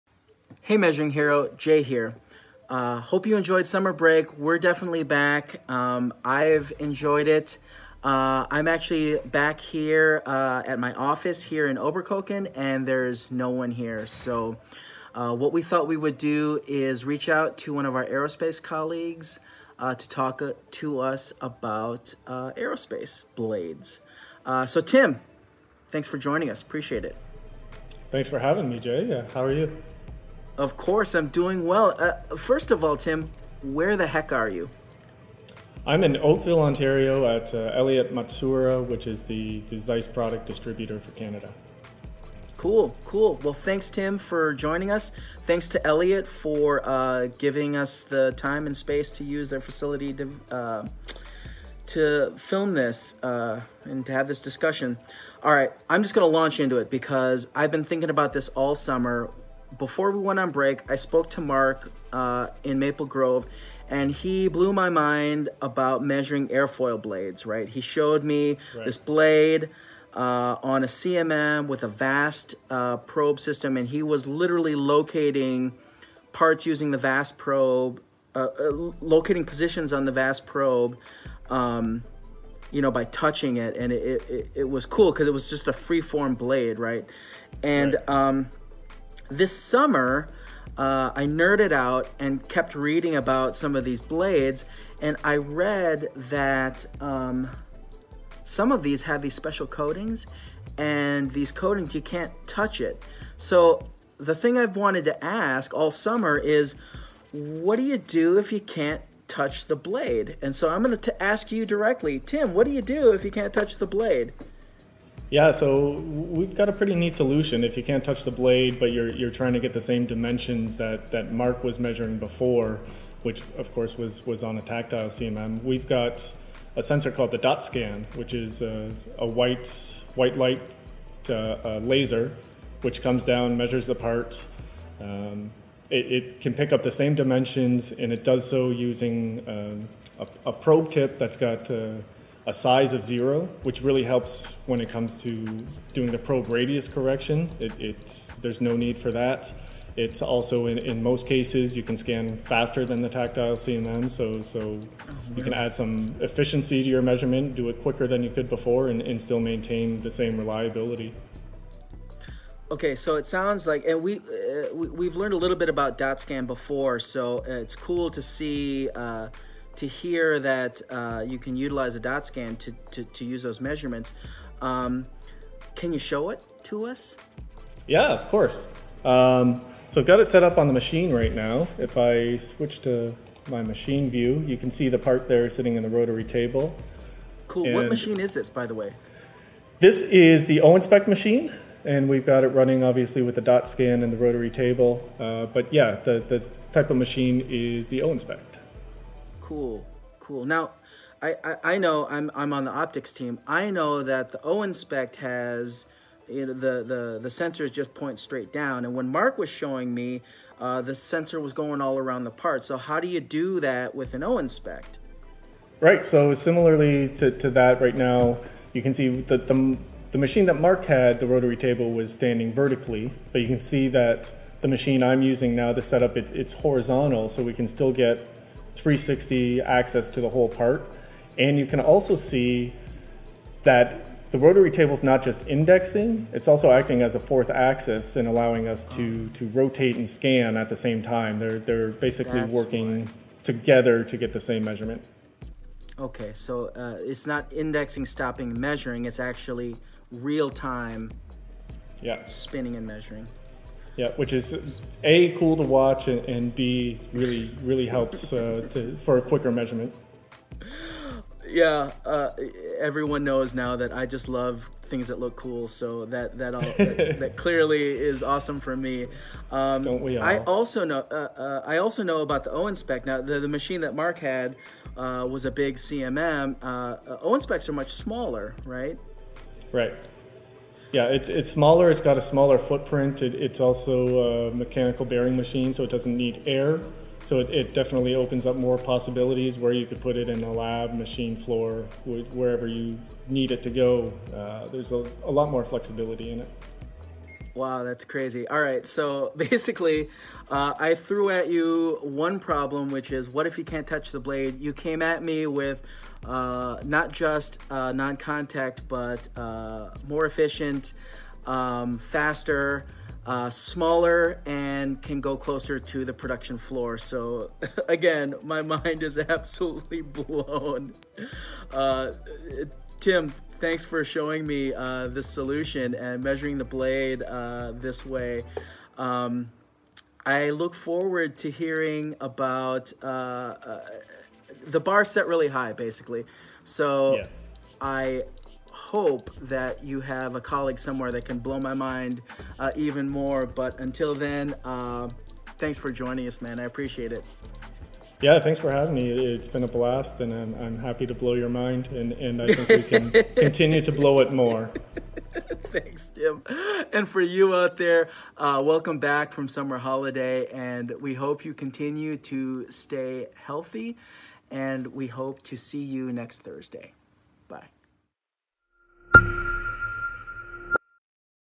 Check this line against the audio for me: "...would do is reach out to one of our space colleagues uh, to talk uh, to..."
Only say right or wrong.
wrong.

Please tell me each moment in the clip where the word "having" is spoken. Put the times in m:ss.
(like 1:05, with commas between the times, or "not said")
0:28, 5:48.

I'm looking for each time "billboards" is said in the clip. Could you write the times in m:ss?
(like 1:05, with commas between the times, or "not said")
not said.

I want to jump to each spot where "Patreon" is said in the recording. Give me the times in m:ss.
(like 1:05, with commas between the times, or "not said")
not said.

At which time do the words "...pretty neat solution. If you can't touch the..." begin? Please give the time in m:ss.
1:56.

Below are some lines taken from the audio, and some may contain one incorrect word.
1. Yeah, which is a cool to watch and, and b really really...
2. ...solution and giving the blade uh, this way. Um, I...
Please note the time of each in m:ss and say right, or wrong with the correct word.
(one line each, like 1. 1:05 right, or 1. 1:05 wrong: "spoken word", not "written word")
1. 4:14 right
2. 5:25 wrong: "measuring", not "giving".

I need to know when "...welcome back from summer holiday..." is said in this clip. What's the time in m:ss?
5:58.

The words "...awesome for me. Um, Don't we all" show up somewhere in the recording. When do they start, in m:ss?
4:28.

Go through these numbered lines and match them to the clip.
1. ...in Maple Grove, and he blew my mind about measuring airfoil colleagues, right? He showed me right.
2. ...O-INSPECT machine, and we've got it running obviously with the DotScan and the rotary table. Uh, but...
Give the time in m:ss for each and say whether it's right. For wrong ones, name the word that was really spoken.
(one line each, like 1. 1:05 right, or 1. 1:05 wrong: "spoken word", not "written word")
1. 1:02 wrong: "blades", not "colleagues"
2. 3:10 right.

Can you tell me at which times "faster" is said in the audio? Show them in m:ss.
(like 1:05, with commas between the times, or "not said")
2:32, 5:11.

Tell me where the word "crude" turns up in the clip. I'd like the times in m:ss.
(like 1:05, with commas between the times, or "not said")
not said.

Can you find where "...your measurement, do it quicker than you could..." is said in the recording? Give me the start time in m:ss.
2:36.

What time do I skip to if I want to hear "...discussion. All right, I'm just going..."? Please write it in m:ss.
0:54.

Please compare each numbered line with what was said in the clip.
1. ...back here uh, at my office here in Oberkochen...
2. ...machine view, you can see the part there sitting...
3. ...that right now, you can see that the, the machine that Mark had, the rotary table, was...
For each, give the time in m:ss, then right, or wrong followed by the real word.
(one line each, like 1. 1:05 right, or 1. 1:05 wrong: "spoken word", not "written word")
1. 0:09 right
2. 3:03 right
3. 3:37 right.